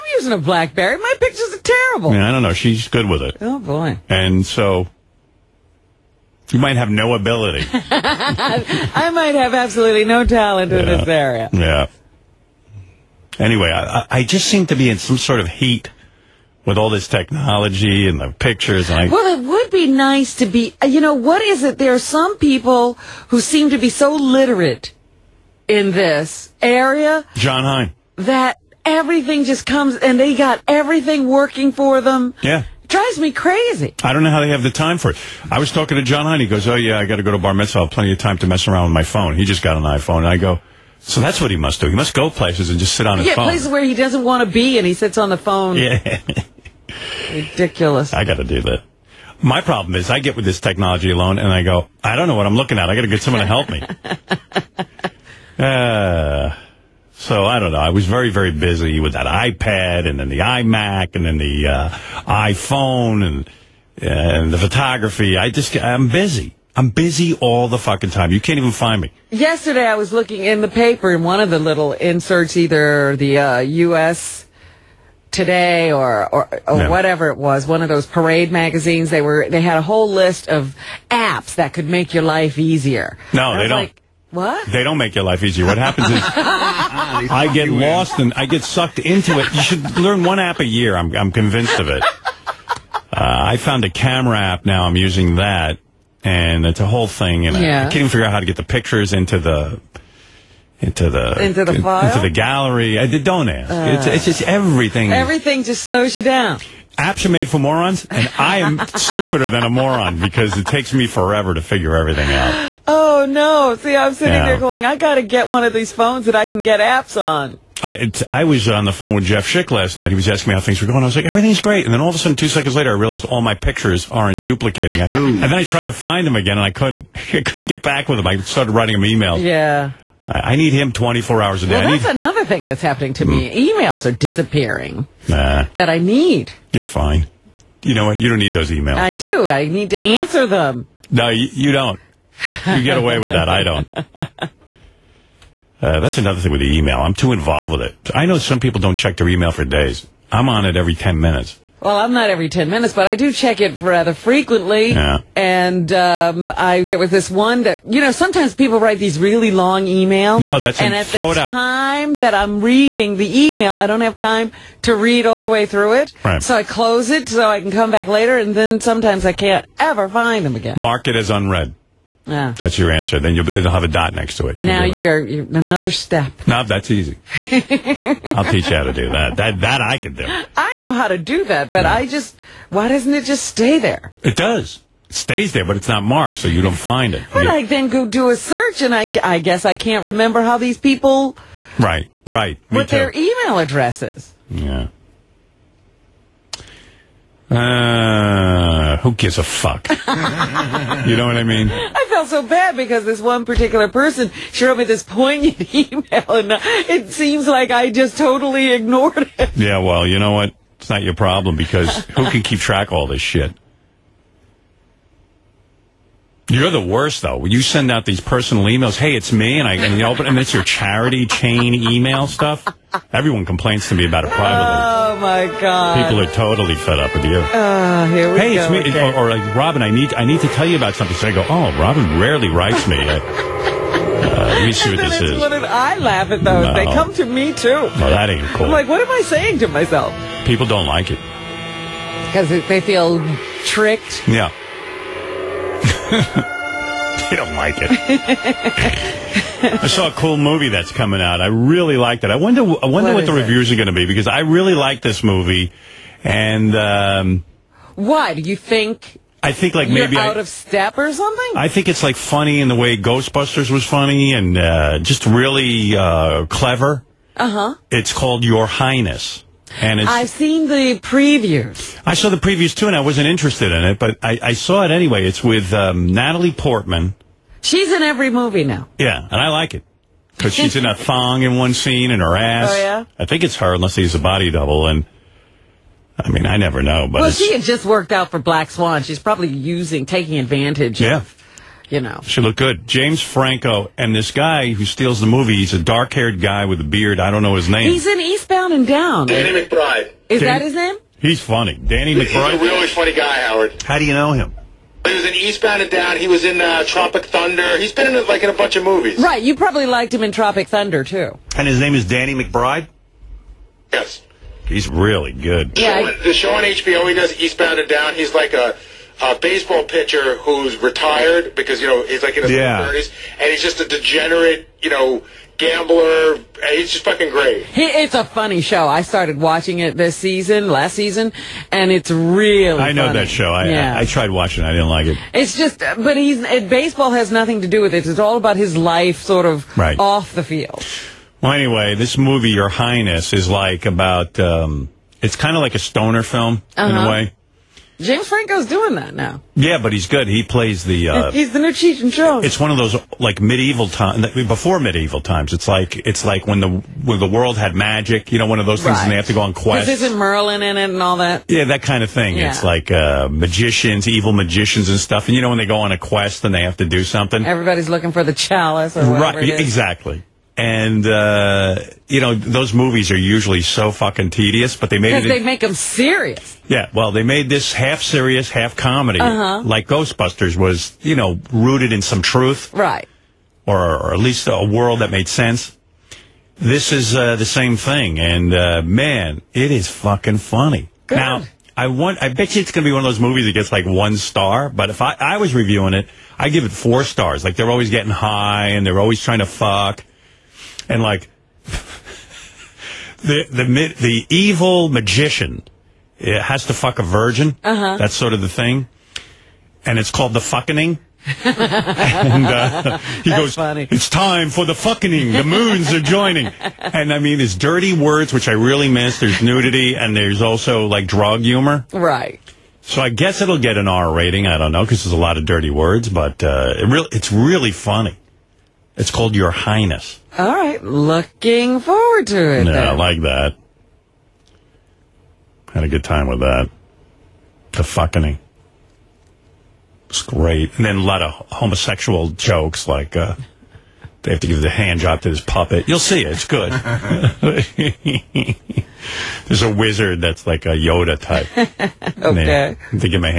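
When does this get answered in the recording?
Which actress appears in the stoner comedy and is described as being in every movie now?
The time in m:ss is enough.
4:36.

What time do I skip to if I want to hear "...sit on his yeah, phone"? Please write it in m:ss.
0:42.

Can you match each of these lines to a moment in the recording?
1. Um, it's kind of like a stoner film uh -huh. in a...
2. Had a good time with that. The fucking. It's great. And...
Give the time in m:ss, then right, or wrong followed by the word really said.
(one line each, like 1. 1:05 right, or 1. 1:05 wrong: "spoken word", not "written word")
1. 5:44 right
2. 7:15 right.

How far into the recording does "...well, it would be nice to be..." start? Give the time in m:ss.
0:19.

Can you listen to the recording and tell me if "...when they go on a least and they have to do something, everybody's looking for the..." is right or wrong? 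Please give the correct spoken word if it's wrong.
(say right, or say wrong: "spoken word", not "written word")
wrong: "quest", not "least".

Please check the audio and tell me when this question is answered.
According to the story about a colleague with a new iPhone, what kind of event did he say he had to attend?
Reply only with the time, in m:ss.
0:37.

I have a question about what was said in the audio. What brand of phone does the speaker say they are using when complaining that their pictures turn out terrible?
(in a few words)
BlackBerry.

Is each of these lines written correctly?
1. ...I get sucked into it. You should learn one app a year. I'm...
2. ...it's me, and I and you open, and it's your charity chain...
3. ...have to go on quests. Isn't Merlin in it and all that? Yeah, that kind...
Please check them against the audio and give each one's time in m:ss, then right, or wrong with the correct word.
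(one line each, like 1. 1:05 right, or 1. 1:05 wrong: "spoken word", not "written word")
1. 1:28 right
2. 3:39 right
3. 5:59 right.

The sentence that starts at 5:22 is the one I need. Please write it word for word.
30s, and he's just a degenerate, you know, gambler.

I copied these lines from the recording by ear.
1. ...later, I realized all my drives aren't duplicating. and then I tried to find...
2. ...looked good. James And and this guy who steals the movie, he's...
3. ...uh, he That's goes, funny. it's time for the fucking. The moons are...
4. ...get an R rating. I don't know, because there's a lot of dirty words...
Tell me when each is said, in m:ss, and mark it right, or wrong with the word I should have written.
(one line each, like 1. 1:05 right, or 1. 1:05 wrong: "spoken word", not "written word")
1. 2:02 wrong: "pictures", not "drives"
2. 4:52 wrong: "Franco", not "And"
3. 6:52 right
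4. 7:03 right.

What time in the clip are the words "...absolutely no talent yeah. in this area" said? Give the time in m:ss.
0:09.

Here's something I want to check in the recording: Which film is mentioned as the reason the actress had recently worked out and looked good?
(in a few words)
Black Swan.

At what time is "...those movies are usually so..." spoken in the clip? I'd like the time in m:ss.
6:12.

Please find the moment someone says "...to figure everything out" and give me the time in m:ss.
1:51.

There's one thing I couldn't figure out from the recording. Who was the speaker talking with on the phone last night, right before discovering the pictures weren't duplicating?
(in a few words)
Jeff Schick.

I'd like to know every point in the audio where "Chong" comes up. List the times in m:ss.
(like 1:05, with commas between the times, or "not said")
5:52.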